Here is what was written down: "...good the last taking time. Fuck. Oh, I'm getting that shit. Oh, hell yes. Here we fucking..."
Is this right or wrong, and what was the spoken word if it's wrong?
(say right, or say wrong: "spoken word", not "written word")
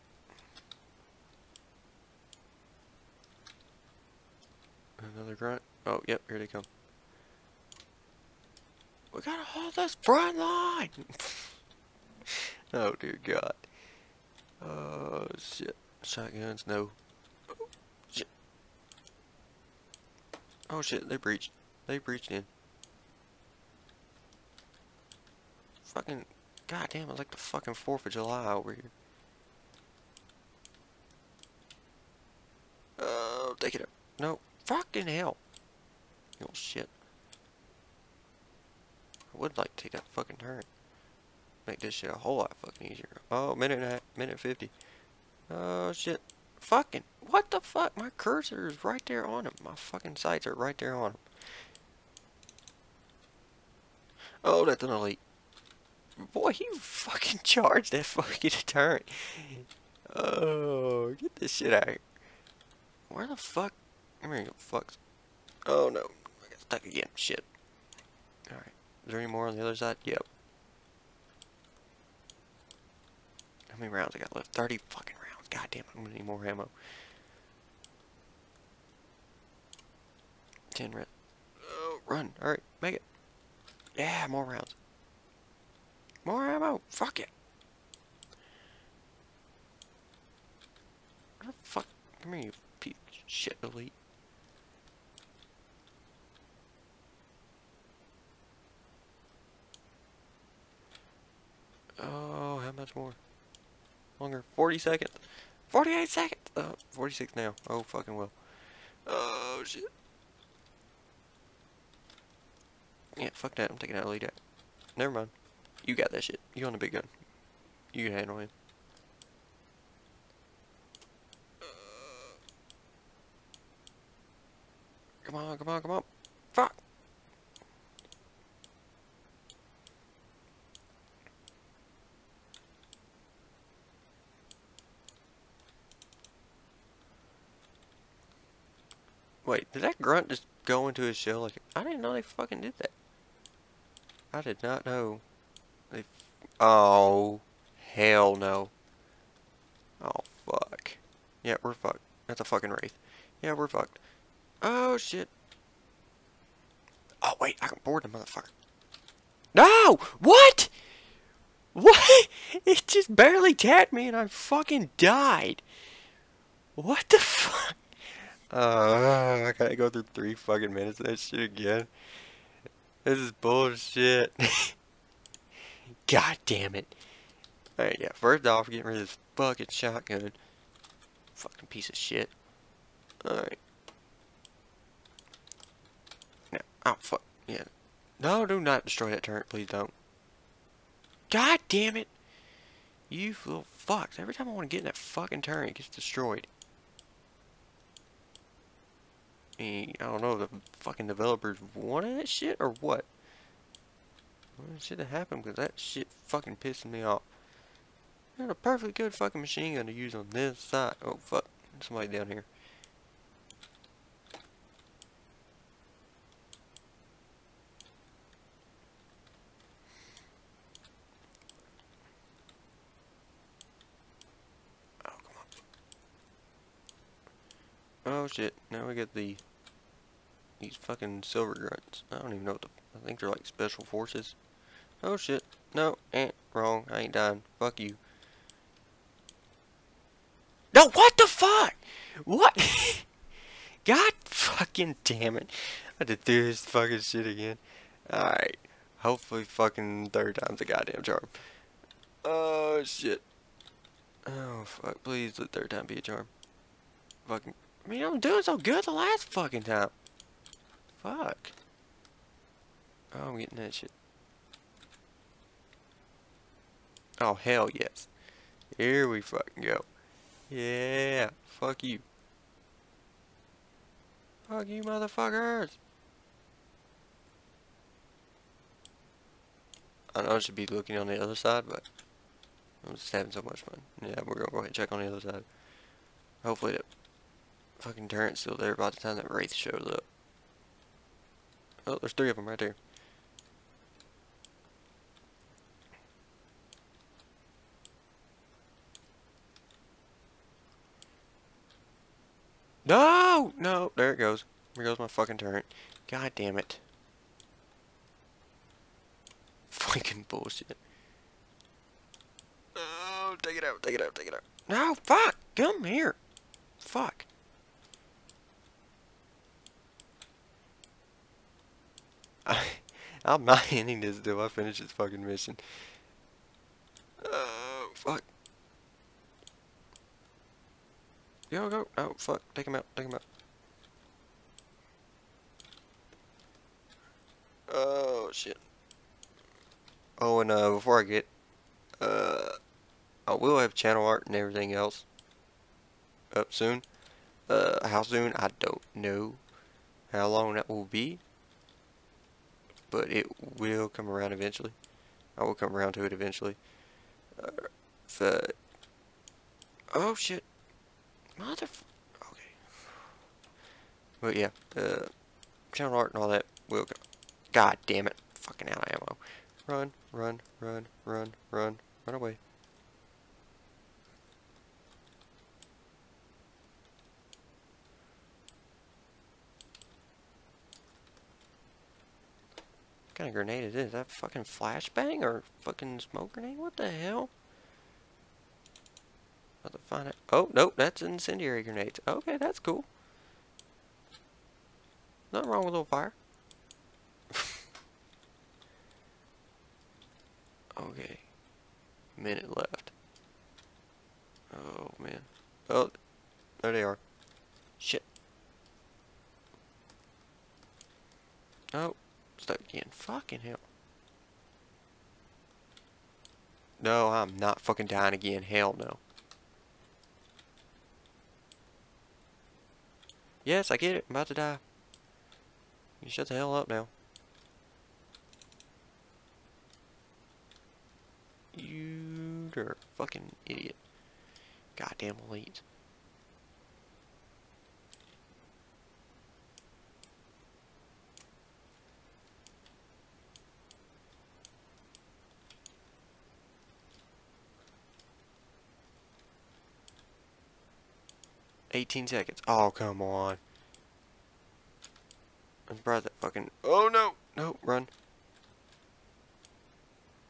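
wrong: "fucking", not "taking".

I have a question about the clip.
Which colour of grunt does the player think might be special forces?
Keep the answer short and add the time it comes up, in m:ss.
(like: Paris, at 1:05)
Silver, at 3:51.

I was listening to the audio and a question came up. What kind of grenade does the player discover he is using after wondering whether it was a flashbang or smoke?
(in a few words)
Incendiary.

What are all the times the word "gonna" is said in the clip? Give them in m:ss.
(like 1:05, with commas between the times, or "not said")
1:16, 4:44.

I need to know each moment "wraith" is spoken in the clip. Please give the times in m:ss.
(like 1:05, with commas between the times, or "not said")
2:32, 4:49.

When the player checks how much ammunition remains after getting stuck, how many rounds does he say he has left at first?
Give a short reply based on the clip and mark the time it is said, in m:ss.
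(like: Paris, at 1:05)
30, at 1:14.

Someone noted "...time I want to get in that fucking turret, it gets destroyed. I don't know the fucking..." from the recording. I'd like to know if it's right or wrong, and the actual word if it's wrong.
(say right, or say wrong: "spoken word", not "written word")
right.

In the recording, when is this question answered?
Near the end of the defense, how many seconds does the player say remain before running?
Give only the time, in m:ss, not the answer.
7:31.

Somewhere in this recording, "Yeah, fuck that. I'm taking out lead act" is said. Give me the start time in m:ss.
1:53.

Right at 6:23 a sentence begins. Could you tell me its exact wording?
Is that fucking flashbang or fucking smoke grenade?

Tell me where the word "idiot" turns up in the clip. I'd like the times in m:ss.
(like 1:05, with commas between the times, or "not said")
7:13.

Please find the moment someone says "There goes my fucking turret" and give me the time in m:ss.
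5:04.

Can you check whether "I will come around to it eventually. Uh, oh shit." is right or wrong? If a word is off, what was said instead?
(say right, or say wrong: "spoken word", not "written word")
right.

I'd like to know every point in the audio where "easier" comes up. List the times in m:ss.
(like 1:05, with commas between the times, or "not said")
0:42.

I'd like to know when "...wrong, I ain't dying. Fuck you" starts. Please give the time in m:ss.
3:56.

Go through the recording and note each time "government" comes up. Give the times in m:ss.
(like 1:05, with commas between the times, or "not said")
not said.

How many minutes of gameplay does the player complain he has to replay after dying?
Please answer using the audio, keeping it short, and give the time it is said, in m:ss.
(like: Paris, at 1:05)
3, at 2:50.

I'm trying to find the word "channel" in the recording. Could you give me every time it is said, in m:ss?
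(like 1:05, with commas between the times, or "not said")
5:43, 6:05.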